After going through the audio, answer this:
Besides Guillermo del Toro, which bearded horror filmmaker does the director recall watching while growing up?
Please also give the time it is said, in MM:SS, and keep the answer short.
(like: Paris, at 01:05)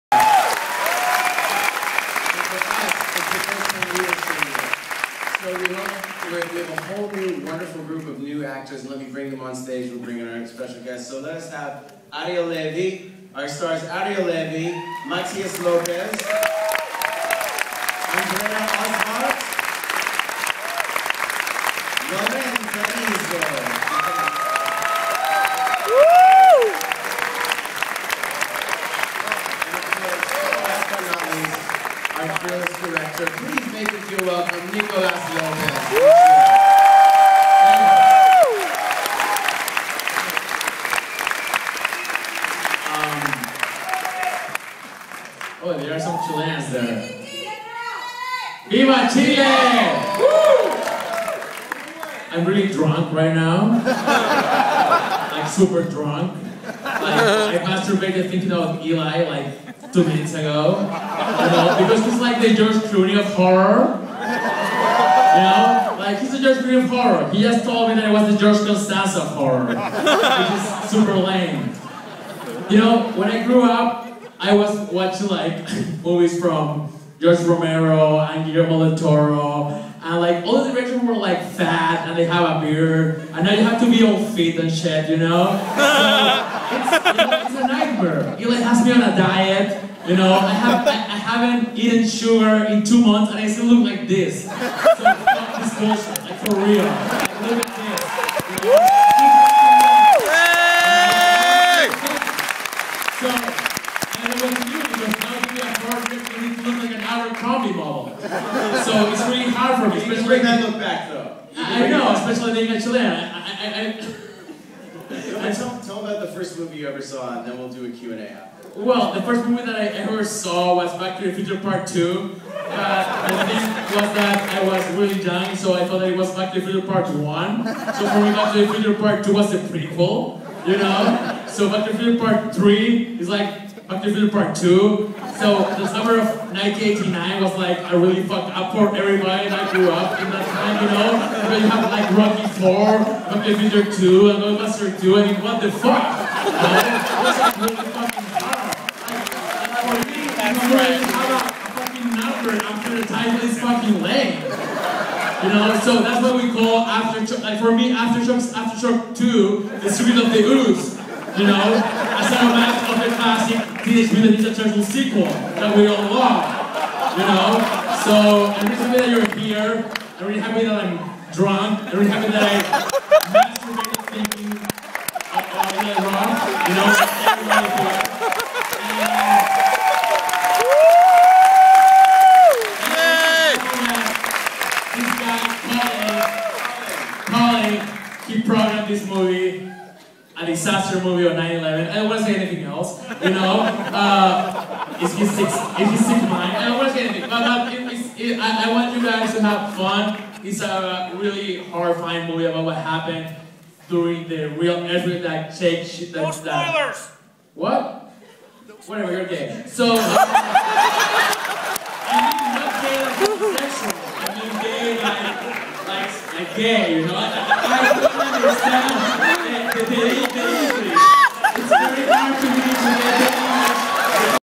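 George Romero, at 01:17.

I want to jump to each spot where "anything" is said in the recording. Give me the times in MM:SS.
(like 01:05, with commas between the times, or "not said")
03:12, 03:17.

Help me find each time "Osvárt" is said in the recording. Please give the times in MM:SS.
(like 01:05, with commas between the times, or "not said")
00:18.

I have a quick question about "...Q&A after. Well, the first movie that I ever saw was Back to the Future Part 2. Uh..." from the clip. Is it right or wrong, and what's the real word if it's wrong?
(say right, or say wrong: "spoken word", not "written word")
right.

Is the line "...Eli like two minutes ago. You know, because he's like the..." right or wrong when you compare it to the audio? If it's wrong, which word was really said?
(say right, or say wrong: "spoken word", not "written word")
right.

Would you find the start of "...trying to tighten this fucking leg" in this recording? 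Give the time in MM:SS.
02:32.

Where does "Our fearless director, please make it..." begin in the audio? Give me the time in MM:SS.
00:32.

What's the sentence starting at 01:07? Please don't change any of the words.
He just told me that it was the George Costanza of horror.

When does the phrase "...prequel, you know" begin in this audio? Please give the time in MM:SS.
02:09.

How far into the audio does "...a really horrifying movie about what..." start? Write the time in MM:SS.
03:20.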